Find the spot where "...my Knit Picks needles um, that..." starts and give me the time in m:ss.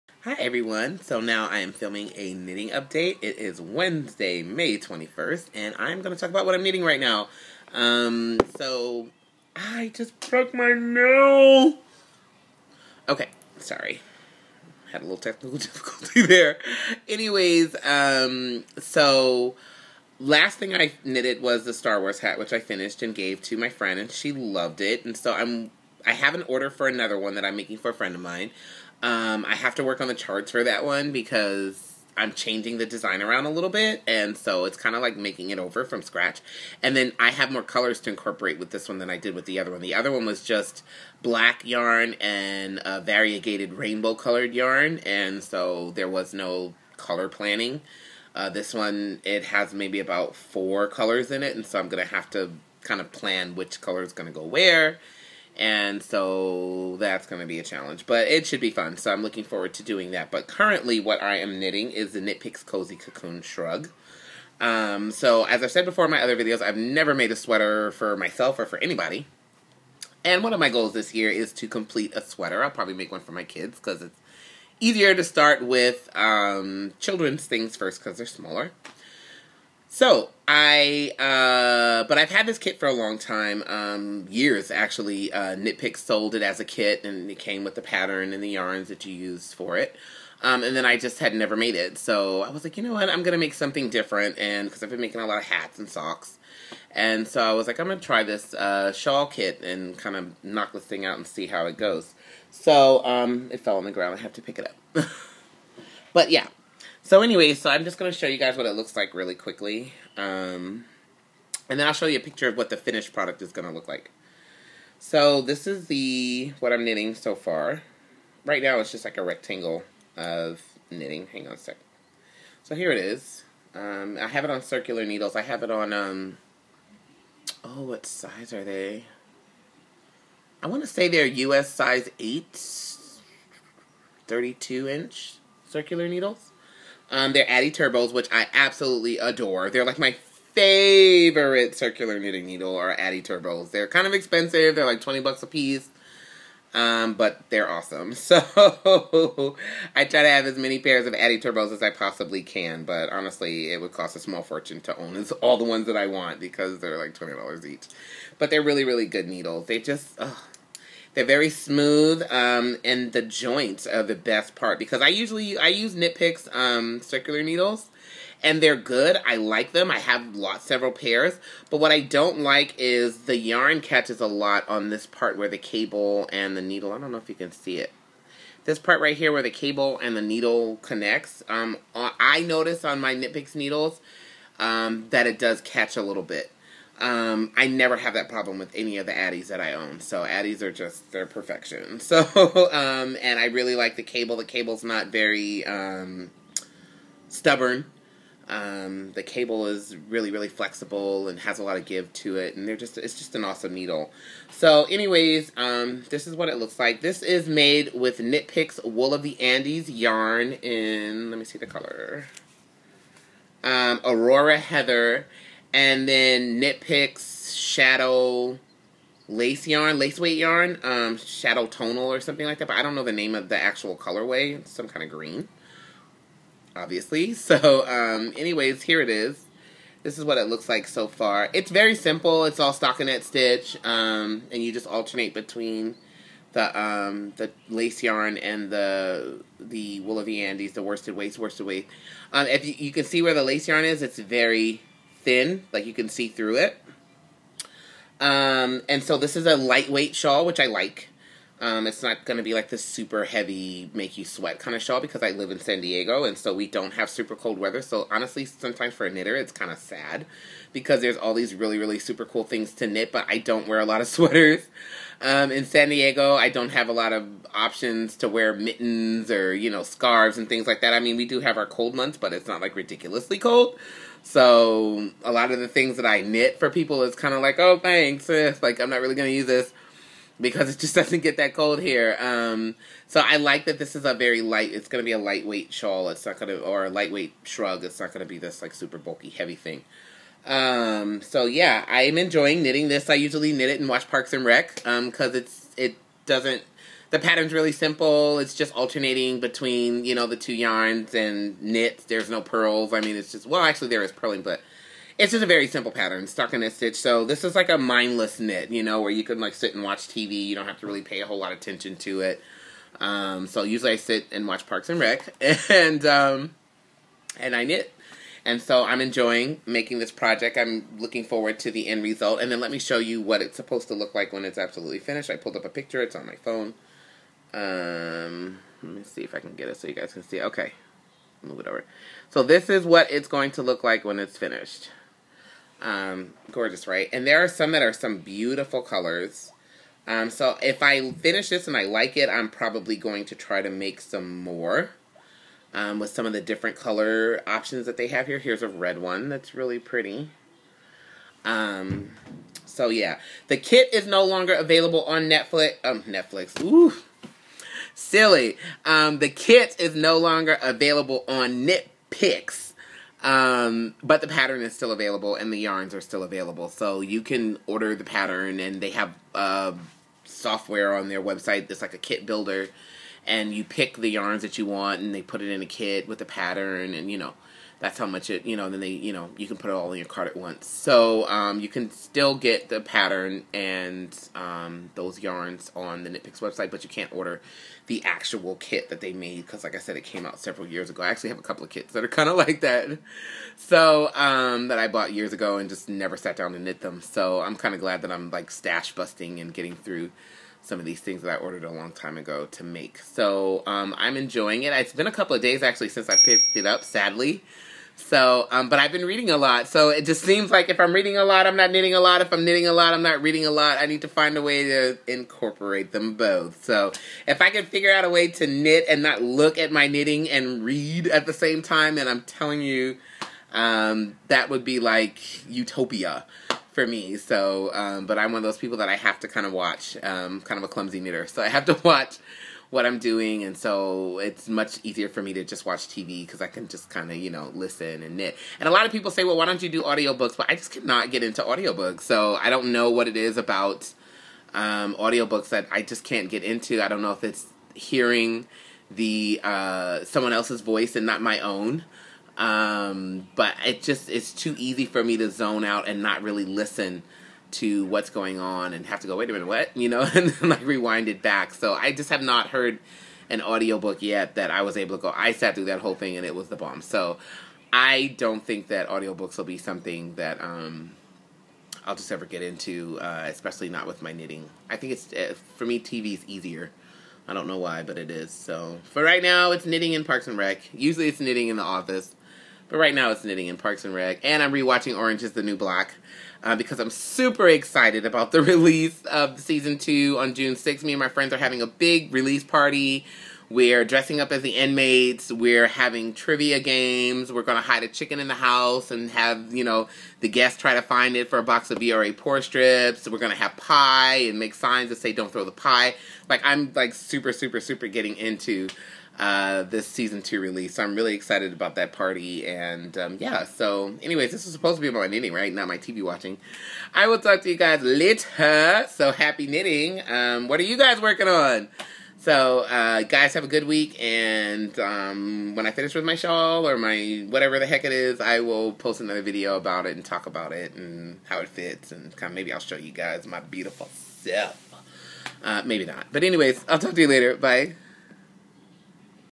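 3:03.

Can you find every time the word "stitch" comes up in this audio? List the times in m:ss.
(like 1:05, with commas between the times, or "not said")
3:53, 5:06.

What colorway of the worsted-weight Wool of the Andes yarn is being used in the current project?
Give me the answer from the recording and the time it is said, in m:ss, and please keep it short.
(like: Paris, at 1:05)
Aurora Heather, at 3:34.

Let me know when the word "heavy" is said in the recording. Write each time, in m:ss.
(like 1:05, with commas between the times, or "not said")
4:13, 4:49.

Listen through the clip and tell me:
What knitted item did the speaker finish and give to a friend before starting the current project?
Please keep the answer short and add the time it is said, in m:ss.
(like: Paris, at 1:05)
Star Wars hat, at 0:21.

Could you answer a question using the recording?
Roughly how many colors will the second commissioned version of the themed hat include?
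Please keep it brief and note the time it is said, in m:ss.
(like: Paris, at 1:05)
4, at 0:50.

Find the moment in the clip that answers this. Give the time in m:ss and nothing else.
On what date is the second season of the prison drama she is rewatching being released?
8:10.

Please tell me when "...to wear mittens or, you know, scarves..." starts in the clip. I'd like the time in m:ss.
4:28.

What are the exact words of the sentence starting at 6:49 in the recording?
So it just seems like if I'm reading a lot, I'm not knitting a lot.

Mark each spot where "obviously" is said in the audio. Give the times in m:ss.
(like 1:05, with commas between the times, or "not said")
3:46.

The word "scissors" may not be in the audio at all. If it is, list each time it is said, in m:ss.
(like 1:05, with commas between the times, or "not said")
not said.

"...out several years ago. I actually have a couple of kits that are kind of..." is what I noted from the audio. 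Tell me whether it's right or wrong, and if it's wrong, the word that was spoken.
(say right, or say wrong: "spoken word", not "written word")
right.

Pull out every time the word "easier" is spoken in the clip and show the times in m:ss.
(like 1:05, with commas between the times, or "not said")
1:14, 7:14, 7:56.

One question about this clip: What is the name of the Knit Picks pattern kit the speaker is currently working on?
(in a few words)
Cozy Cocoon Shrug.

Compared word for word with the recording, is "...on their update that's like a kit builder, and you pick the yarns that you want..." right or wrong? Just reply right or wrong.
wrong.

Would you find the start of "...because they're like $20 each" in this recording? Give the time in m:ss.
2:36.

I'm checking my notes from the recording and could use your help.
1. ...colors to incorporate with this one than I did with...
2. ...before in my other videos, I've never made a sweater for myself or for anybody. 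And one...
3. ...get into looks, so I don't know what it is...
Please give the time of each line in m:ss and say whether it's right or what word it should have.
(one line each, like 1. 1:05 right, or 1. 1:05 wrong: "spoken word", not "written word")
1. 0:37 right
2. 1:05 right
3. 7:21 wrong: "audiobooks", not "looks".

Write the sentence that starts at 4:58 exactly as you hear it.
It's just alternating between, you know, the two yarns and knits.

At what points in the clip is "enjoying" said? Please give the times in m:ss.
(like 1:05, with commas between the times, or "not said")
4:52, 5:19, 6:44.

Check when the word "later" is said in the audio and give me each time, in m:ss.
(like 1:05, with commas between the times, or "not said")
8:37, 8:57.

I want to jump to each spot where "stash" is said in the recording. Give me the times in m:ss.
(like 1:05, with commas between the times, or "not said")
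6:38.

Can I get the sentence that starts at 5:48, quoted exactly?
Here's a red one that's really pretty.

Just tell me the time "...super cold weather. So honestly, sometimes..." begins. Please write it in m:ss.
4:17.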